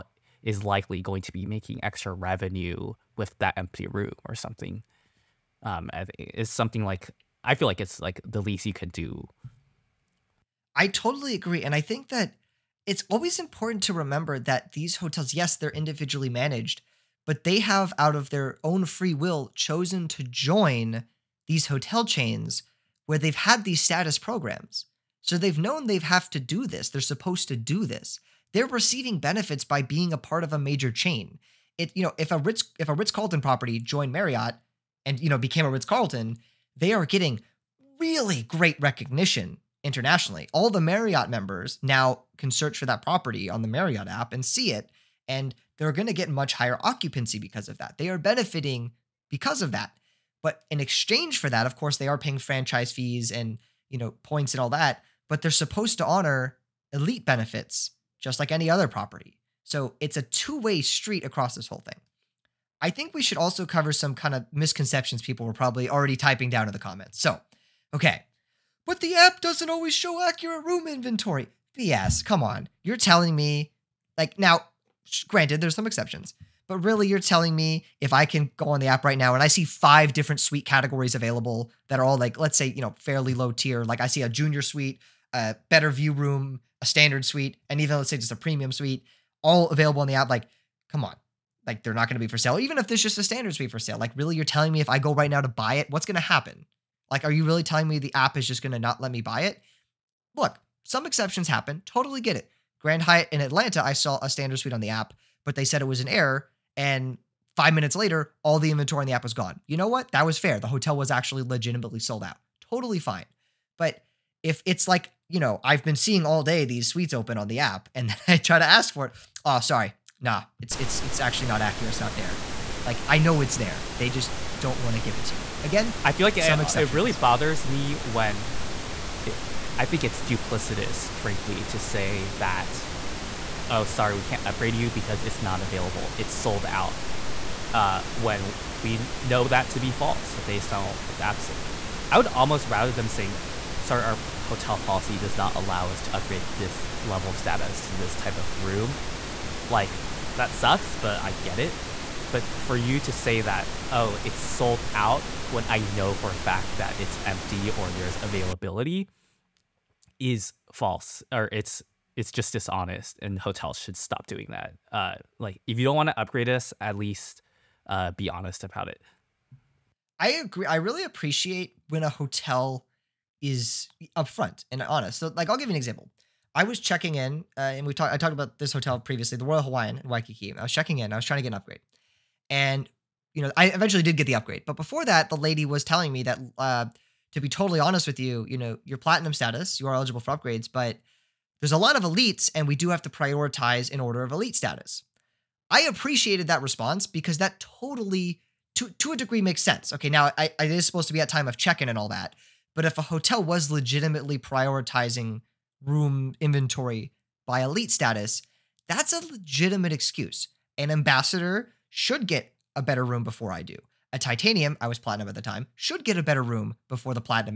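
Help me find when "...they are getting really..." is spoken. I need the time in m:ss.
0:36.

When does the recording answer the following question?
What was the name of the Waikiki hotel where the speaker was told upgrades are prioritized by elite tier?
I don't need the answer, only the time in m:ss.
2:59.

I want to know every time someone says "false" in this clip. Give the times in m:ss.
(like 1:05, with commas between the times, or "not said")
2:19, 2:40.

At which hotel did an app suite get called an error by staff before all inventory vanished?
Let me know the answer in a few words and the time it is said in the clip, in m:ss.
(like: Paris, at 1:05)
Grand Hyatt in Atlanta, at 1:42.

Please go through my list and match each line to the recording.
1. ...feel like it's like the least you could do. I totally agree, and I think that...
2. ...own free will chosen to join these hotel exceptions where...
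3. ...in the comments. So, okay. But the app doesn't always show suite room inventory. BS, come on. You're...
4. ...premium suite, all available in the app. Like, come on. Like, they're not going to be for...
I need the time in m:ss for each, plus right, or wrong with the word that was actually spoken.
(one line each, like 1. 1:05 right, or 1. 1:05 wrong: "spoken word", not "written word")
1. 0:07 right
2. 0:18 wrong: "chains", not "exceptions"
3. 1:06 wrong: "accurate", not "suite"
4. 1:28 right.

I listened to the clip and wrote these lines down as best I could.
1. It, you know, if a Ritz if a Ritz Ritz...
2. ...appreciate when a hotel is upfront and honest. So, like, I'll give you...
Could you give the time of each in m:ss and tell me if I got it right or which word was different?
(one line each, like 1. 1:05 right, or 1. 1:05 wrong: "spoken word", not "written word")
1. 0:31 wrong: "Carlton", not "Ritz"
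2. 2:51 right.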